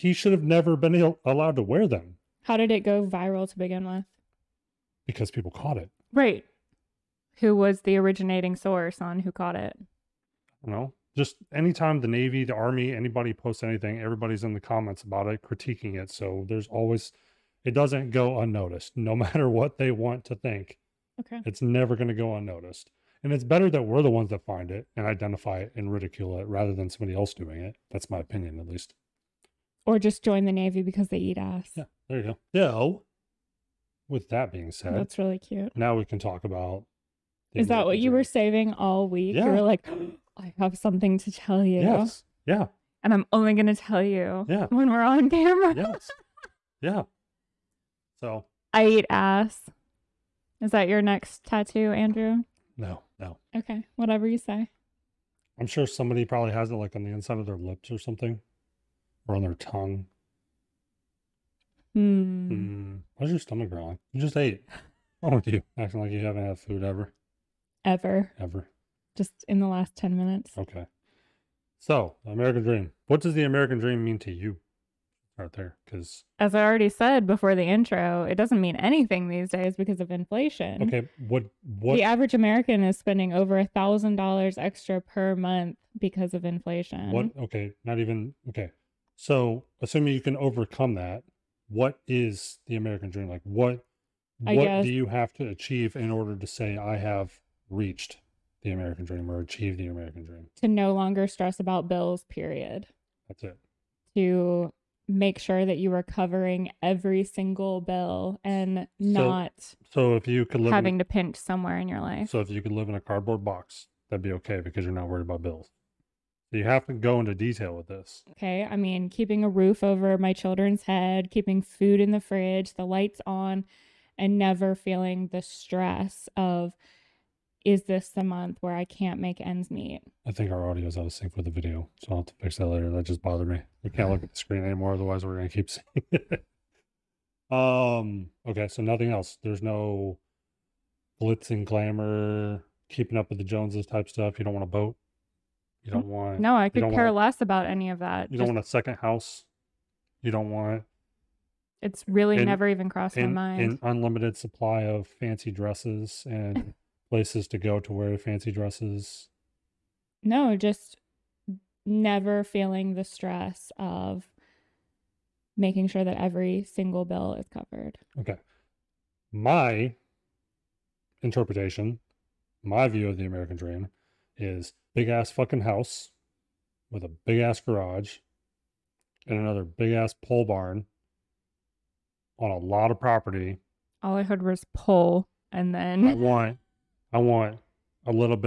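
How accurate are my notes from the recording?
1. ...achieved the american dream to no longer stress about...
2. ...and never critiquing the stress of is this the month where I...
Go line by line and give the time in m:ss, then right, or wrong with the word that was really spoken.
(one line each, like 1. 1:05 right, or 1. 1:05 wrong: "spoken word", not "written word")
1. 1:39 right
2. 2:04 wrong: "feeling", not "critiquing".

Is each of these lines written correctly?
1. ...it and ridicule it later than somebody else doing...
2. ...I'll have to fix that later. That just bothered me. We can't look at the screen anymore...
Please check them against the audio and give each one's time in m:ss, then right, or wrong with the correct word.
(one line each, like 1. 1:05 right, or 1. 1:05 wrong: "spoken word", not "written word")
1. 0:25 wrong: "rather", not "later"
2. 2:12 right.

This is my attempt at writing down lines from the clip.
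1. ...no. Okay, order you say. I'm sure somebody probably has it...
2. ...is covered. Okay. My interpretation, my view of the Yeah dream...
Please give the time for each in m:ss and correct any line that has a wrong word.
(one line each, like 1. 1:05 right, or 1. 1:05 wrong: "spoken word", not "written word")
1. 0:53 wrong: "whatever", not "order"
2. 2:47 wrong: "American", not "Yeah".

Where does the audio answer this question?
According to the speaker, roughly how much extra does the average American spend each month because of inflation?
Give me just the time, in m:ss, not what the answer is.
1:23.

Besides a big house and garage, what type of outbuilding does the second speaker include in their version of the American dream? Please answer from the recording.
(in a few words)
pole barn.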